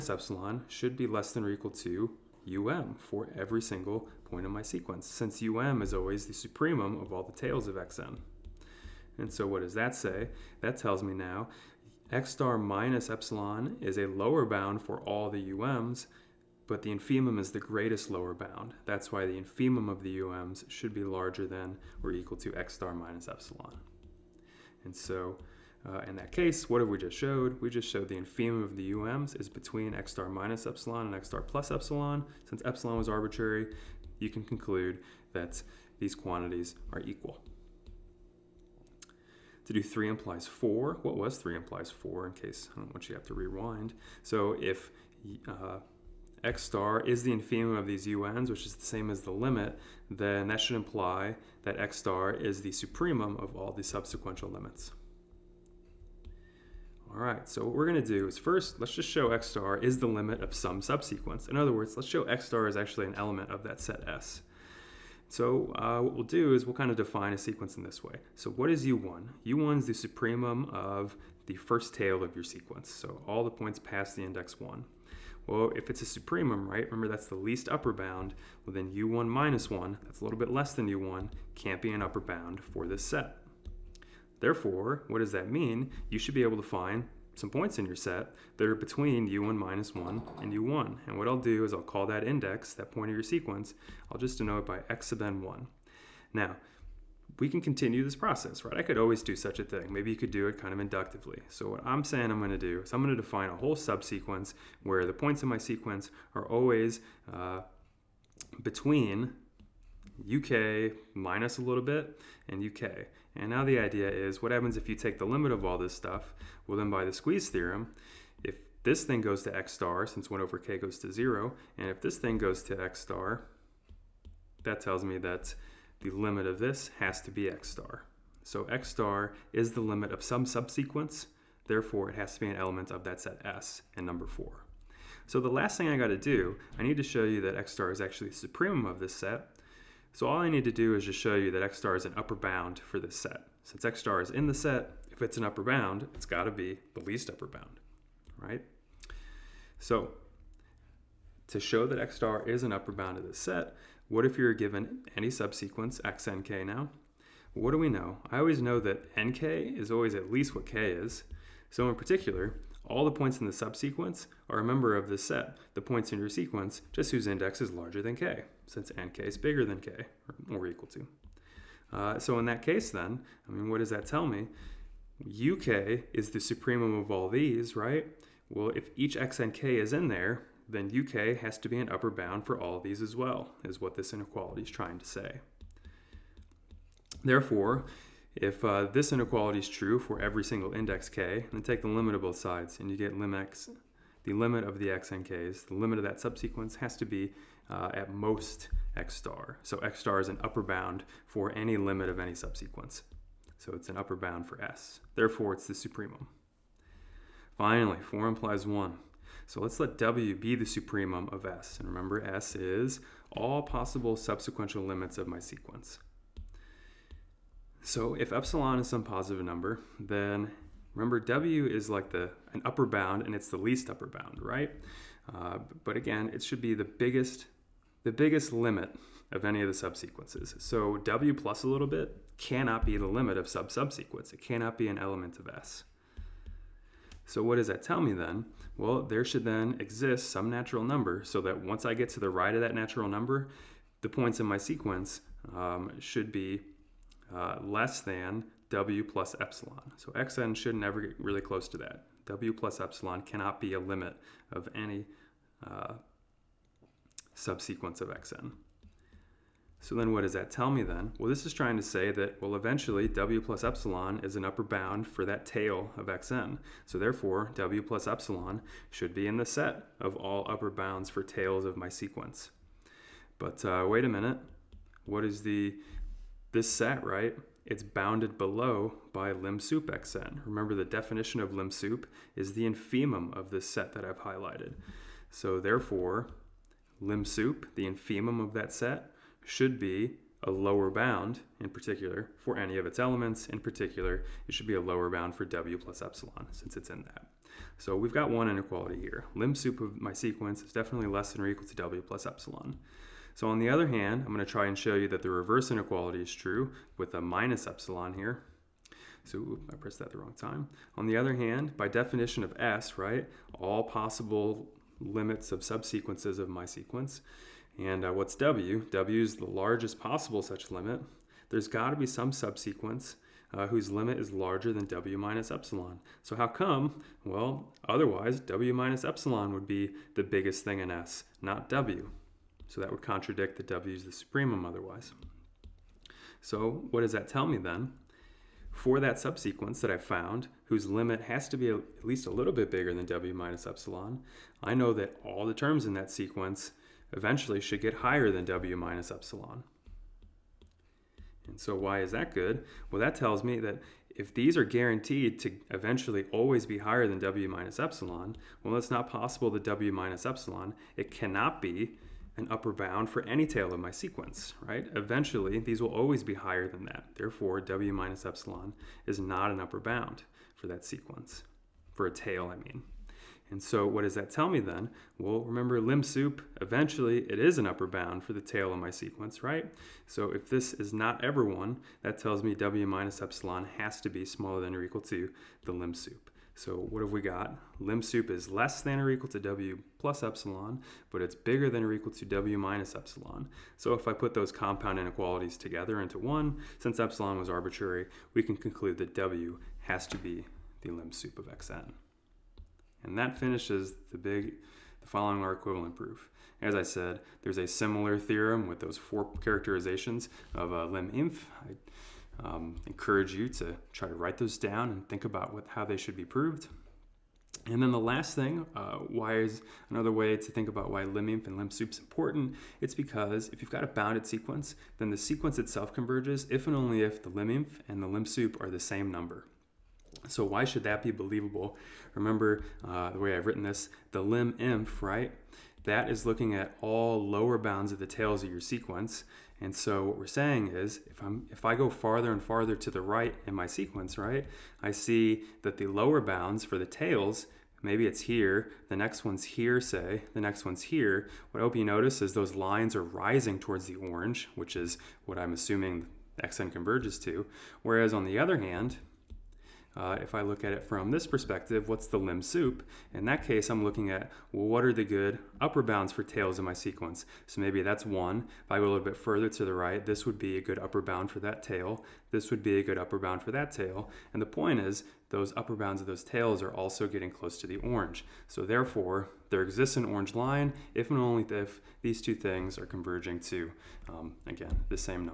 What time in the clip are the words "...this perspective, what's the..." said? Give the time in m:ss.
7:41.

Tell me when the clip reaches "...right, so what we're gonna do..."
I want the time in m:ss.
0:57.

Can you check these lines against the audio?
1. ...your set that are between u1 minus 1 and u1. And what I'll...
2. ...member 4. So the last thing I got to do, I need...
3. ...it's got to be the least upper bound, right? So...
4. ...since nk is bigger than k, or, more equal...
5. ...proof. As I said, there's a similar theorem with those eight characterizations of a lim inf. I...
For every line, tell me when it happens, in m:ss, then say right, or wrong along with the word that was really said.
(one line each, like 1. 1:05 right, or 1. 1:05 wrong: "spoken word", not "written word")
1. 1:27 right
2. 2:14 wrong: "number", not "member"
3. 2:26 right
4. 2:48 right
5. 6:45 wrong: "four", not "eight".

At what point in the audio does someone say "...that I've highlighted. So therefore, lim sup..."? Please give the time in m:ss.
4:43.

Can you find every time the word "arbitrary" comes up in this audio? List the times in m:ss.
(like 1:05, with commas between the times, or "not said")
0:33, 6:37.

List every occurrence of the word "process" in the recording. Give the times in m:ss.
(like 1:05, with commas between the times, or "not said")
1:38.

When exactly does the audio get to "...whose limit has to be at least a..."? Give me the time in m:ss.
5:40.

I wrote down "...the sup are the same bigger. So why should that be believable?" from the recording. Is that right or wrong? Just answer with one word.
wrong.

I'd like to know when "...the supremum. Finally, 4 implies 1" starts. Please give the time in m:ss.
3:25.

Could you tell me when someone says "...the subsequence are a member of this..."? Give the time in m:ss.
2:43.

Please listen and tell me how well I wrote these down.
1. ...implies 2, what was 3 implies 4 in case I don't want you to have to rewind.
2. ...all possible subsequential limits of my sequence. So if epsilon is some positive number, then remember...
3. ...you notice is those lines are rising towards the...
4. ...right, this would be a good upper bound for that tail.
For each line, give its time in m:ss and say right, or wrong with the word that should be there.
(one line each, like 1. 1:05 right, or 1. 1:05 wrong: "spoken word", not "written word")
1. 0:40 wrong: "4", not "2"
2. 3:33 right
3. 7:31 right
4. 7:49 right.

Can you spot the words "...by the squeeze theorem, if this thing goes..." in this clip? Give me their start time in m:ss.
1:56.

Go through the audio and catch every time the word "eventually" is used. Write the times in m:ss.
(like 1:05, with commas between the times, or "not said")
4:22, 5:47, 5:55, 6:04, 6:16.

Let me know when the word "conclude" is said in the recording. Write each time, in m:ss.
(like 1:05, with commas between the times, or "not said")
0:34, 6:38.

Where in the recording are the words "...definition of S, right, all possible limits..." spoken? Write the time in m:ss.
5:11.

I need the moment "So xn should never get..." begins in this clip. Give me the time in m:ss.
4:09.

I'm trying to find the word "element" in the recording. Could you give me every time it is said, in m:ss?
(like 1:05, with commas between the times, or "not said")
1:03, 2:12, 3:54, 4:52.